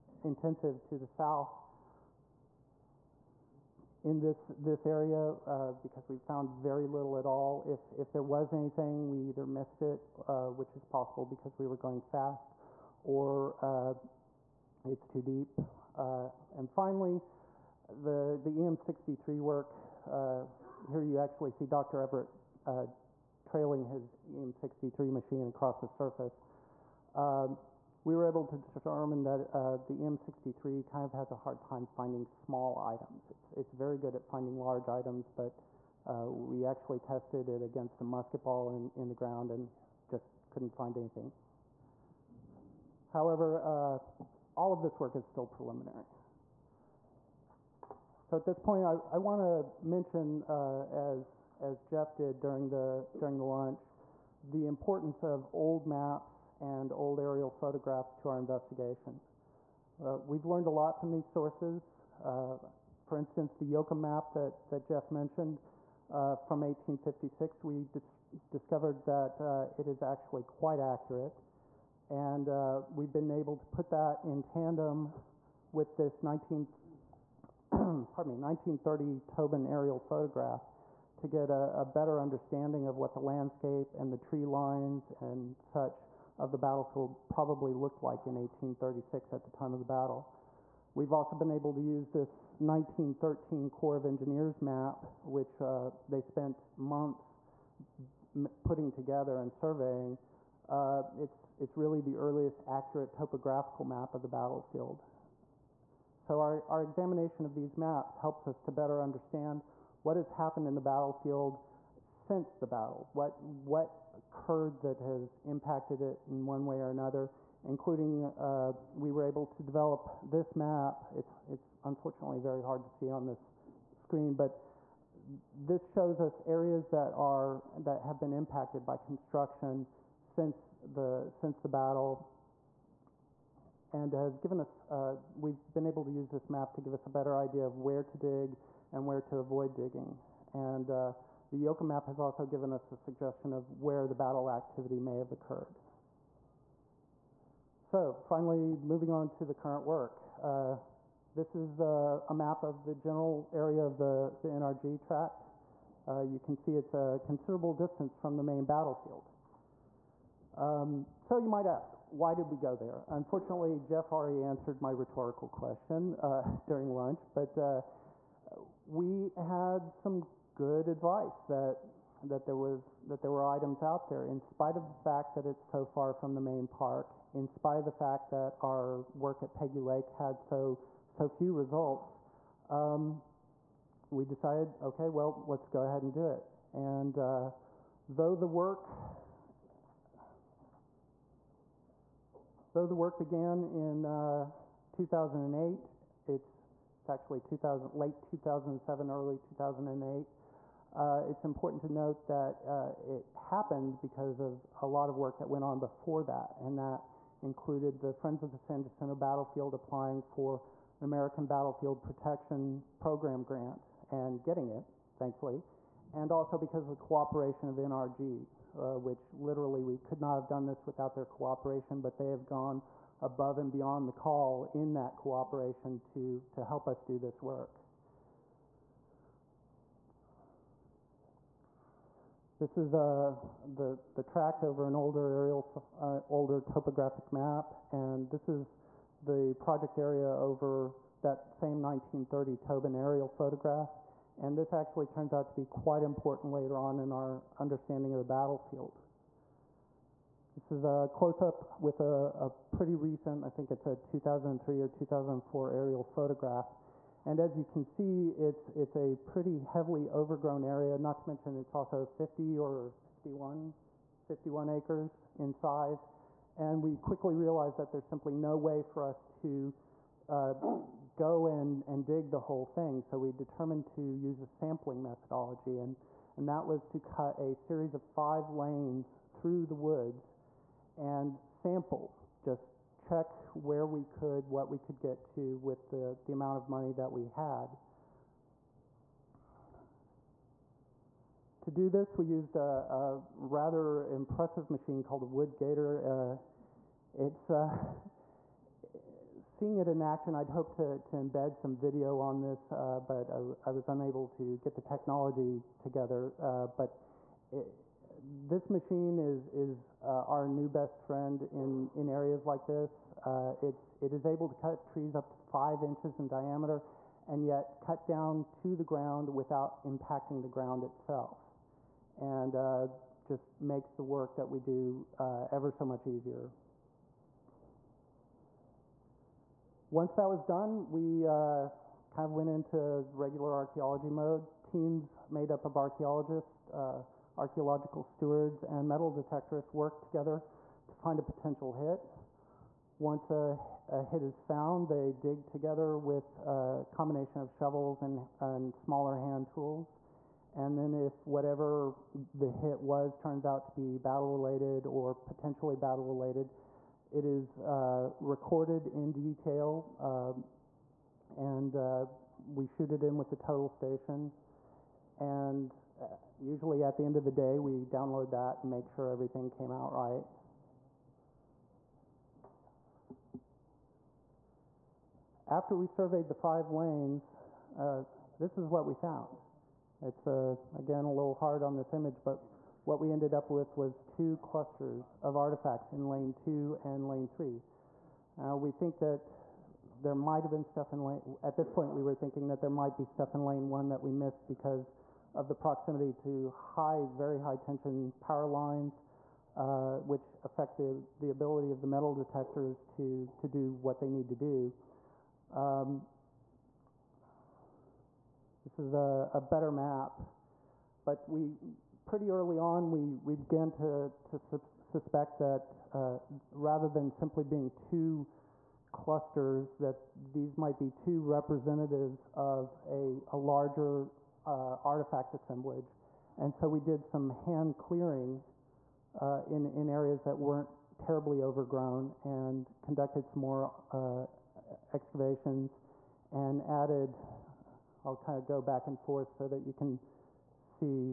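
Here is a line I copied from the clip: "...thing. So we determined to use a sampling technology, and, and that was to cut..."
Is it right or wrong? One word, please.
wrong.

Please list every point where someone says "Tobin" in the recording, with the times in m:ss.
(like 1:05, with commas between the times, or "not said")
1:19, 4:02.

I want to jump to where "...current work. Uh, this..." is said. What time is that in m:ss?
2:29.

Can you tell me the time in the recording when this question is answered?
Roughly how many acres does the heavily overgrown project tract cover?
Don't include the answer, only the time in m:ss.
4:24.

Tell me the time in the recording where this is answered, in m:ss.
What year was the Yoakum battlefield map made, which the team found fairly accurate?
1:06.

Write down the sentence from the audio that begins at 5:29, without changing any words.
Once that was done, we uh, kind of went into regular archaeology mode.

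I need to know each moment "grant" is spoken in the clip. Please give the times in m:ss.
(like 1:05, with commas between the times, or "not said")
3:33.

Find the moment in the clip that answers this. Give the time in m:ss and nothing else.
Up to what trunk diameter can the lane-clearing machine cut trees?
5:15.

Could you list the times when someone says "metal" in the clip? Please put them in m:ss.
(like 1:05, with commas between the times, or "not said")
5:38, 6:41.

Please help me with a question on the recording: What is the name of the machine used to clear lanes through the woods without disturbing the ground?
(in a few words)
wood gator.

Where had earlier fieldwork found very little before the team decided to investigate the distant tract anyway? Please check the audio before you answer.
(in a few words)
Peggy Lake.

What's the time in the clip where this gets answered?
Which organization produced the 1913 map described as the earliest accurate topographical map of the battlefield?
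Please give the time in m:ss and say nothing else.
1:33.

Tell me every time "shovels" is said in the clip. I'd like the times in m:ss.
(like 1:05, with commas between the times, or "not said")
5:47.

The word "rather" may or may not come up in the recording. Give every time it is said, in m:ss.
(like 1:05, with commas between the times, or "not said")
4:53, 6:56.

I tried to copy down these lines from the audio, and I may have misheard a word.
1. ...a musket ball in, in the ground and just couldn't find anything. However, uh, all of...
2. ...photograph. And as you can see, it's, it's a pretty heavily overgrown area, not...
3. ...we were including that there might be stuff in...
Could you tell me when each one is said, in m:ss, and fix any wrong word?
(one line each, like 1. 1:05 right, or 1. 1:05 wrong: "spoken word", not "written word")
1. 0:37 right
2. 4:16 right
3. 6:31 wrong: "thinking", not "including".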